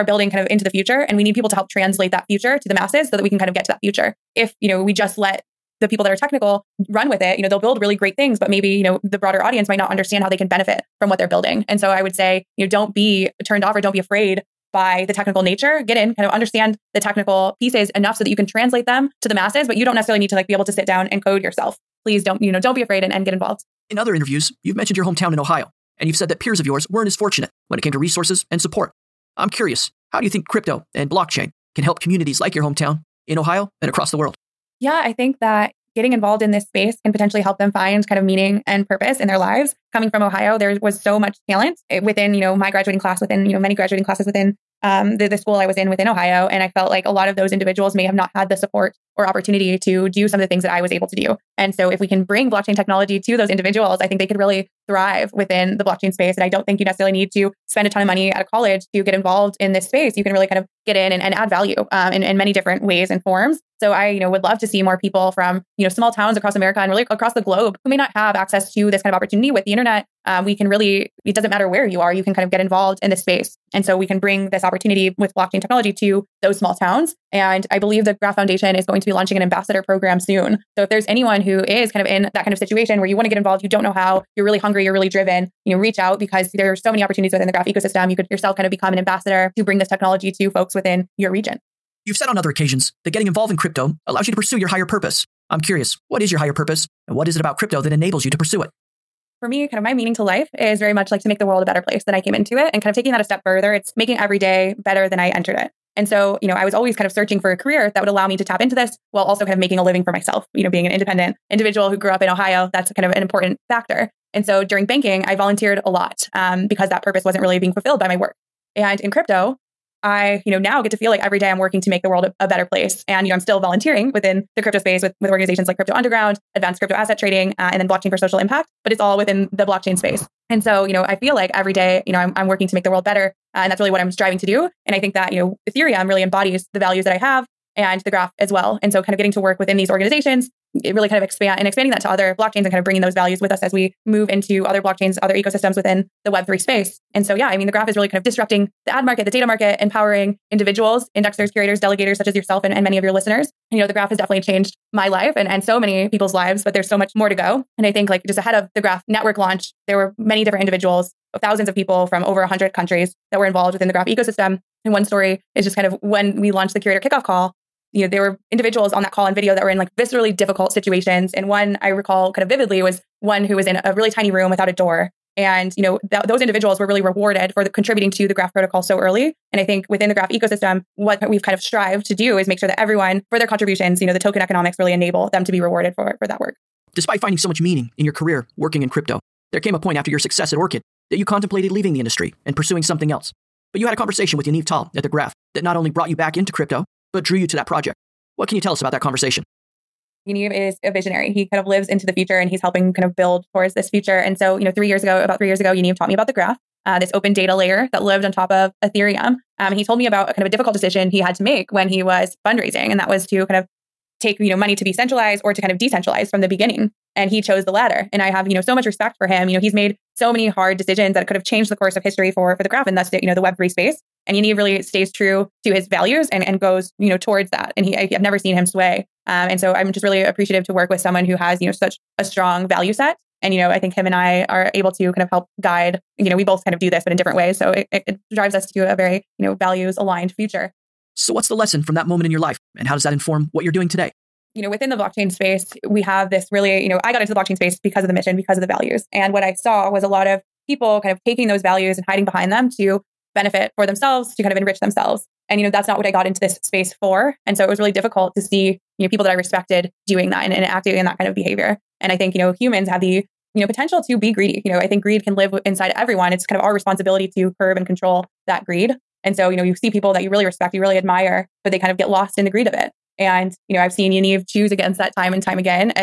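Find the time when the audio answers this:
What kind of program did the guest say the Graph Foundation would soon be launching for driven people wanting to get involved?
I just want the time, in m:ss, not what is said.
1:19.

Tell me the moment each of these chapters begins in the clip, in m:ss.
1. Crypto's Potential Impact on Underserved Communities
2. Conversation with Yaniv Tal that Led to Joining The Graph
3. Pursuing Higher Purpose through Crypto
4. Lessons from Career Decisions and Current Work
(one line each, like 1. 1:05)
1. 0:23
2. 3:06
3. 1:31
4. 4:00.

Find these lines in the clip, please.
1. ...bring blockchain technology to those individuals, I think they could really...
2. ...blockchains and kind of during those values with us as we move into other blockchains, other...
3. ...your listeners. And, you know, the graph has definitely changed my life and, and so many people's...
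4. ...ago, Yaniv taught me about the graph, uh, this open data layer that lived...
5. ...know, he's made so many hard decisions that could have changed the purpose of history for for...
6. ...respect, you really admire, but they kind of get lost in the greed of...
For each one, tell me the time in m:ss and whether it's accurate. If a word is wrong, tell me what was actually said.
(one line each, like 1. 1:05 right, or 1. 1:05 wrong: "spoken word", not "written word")
1. 0:52 right
2. 2:22 wrong: "bringing", not "during"
3. 2:33 right
4. 3:25 right
5. 3:39 wrong: "course", not "purpose"
6. 4:30 right.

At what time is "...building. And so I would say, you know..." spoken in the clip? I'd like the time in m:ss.
0:11.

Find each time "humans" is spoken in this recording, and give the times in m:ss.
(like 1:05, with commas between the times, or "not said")
4:22.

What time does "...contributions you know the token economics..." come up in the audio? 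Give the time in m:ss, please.
3:03.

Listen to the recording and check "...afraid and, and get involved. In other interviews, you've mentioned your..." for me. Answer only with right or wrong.
right.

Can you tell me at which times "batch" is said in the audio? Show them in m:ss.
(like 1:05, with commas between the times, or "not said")
not said.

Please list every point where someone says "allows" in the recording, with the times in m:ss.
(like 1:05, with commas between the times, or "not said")
1:34, 1:48.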